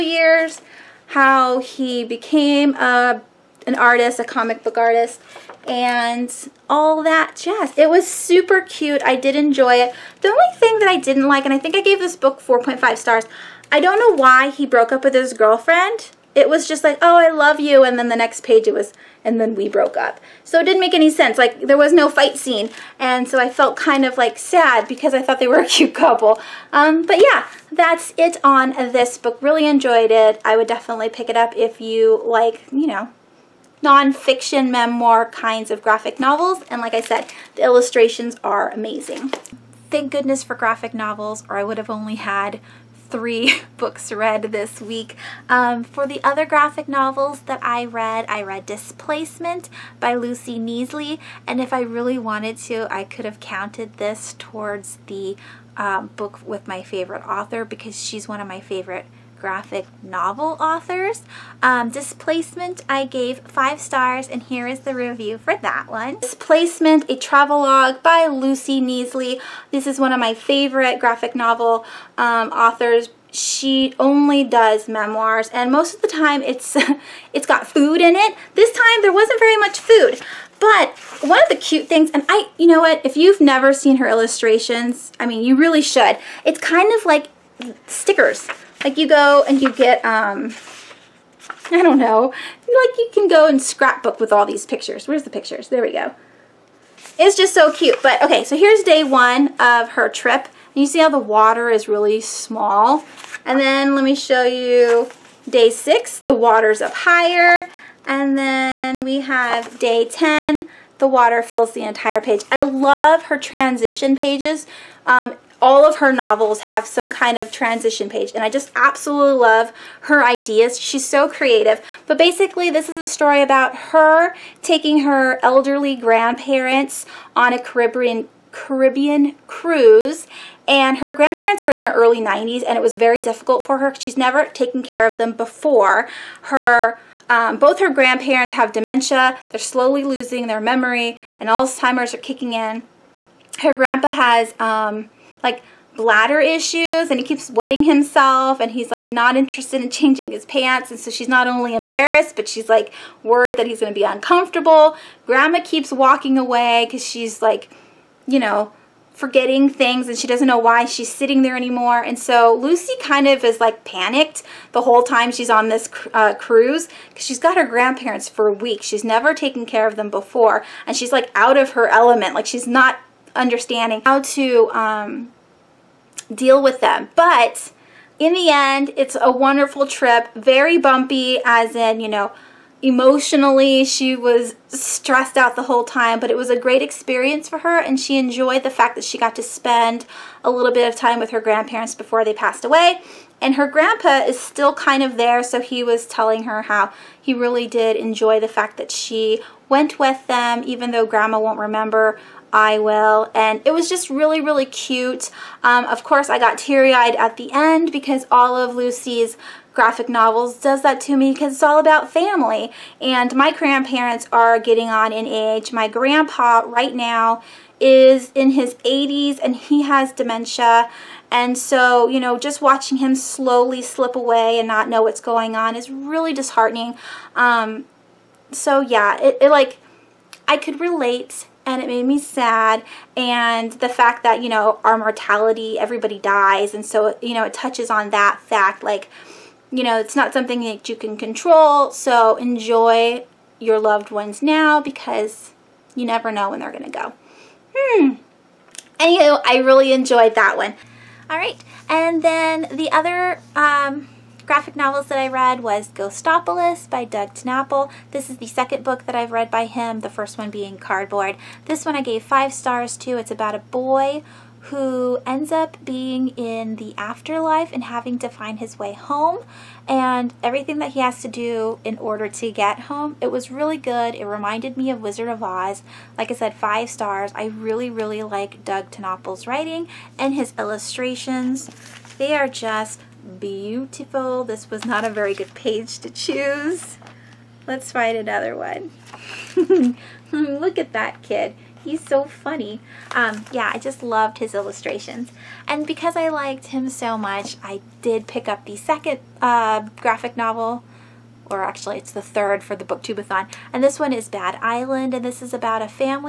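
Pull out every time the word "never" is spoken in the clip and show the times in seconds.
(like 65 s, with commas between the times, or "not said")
83 s, 134 s, 169 s, 246 s.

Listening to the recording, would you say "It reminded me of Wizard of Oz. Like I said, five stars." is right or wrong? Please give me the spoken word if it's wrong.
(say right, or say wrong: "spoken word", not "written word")
right.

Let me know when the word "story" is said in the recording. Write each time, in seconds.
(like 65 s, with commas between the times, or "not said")
123 s.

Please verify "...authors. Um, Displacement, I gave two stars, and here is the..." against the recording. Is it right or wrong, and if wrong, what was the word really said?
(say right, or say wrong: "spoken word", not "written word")
wrong: "five", not "two".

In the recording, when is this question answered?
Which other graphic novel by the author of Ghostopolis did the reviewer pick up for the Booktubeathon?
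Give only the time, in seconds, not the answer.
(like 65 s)
304 s.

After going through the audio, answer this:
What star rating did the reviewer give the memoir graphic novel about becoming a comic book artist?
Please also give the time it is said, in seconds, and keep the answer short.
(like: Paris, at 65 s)
4.5 stars, at 12 s.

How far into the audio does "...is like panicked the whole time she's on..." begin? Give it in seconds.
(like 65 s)
163 s.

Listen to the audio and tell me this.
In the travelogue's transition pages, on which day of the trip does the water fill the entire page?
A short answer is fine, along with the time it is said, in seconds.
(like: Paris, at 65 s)
Day 10, at 109 s.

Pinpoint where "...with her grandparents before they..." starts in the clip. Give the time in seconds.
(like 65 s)
191 s.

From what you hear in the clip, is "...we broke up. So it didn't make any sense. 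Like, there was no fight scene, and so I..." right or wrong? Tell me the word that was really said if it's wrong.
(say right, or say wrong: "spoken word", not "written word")
right.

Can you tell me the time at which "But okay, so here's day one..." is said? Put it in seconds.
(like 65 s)
98 s.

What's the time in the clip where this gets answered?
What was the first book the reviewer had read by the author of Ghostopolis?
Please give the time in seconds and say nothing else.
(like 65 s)
260 s.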